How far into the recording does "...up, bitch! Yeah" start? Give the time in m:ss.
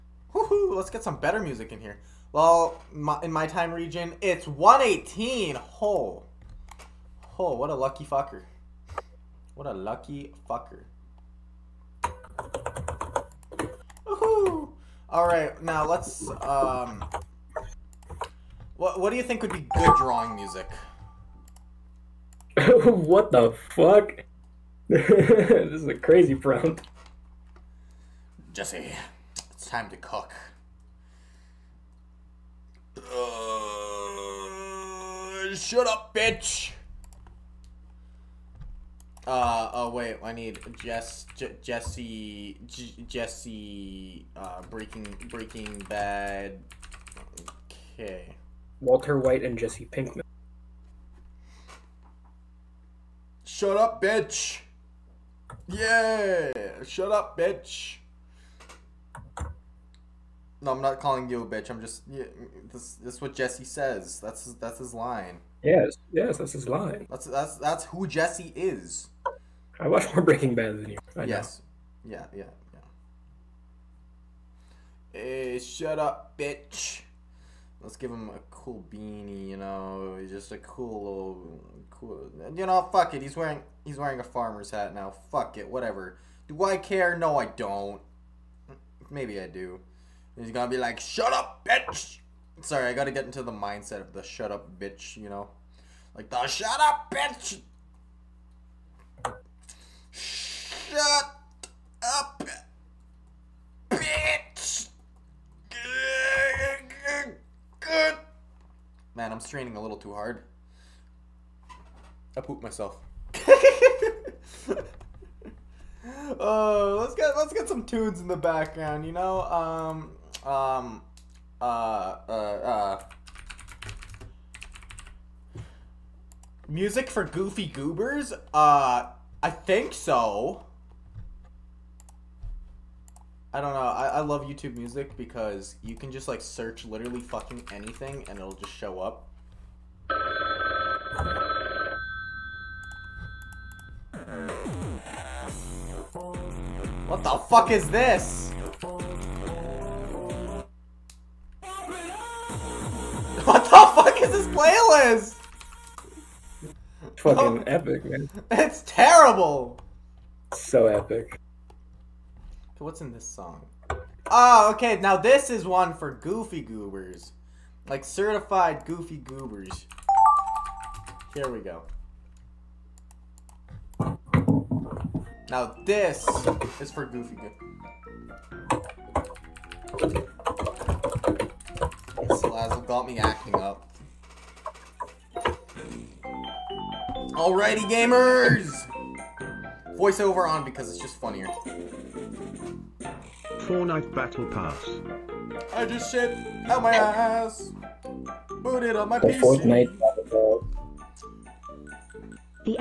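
0:53.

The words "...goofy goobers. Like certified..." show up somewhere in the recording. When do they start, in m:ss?
2:46.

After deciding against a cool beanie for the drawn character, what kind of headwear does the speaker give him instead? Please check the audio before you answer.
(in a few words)
A farmer's hat.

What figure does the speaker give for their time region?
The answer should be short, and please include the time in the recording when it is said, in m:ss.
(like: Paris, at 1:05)
118, at 0:04.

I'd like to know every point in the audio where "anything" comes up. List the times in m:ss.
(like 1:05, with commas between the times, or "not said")
2:17.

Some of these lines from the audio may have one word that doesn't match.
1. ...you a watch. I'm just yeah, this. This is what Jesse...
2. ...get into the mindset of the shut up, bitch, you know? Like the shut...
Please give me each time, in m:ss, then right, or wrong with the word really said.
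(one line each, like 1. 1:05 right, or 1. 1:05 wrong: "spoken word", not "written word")
1. 1:01 wrong: "bitch", not "watch"
2. 1:33 right.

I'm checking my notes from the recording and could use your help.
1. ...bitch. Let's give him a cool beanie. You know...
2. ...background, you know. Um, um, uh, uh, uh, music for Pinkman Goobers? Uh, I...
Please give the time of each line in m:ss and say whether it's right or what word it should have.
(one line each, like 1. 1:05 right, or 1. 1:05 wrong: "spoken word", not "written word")
1. 1:16 right
2. 1:58 wrong: "Goofy", not "Pinkman".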